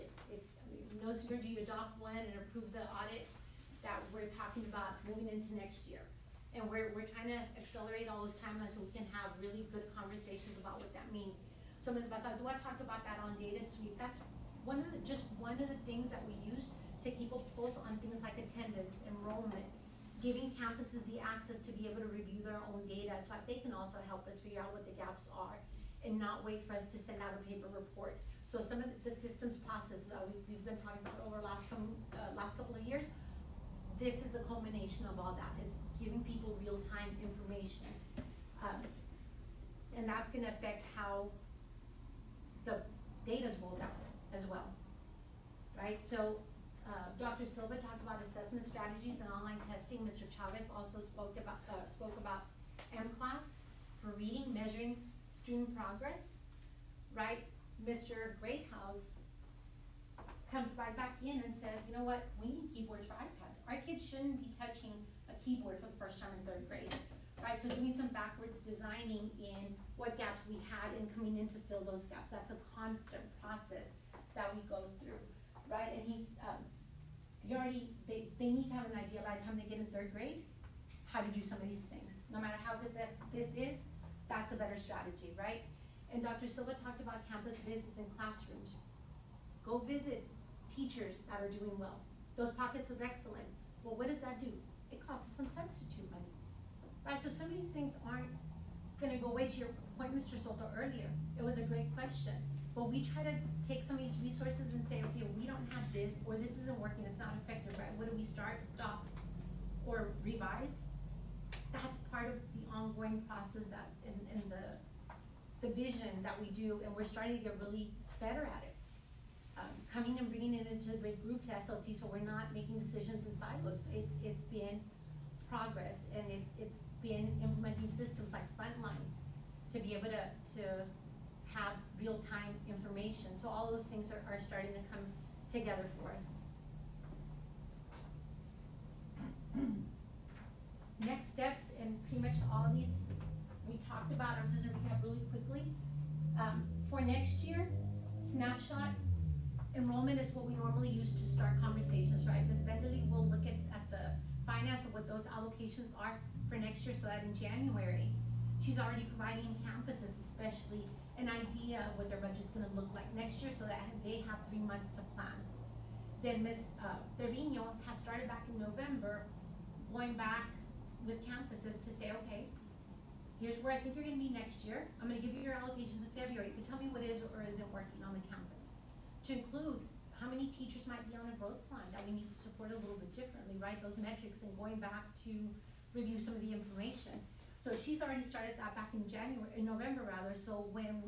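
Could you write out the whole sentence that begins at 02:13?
So all those things are, are starting to come together for us.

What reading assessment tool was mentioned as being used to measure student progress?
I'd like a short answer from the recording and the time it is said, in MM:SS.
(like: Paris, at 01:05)
mCLASS, at 00:52.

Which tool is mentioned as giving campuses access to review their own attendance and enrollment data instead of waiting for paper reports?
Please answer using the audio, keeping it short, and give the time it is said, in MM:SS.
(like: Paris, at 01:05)
Data Suite, at 00:13.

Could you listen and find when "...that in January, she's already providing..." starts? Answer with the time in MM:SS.
02:37.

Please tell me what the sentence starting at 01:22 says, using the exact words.
No matter how good that this is, that's a better strategy, right?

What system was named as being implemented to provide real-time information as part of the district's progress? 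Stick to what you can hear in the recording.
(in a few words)
Frontline.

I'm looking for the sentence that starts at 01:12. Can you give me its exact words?
That's a constant process that we go through, right?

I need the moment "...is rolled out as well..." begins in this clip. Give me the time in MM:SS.
00:43.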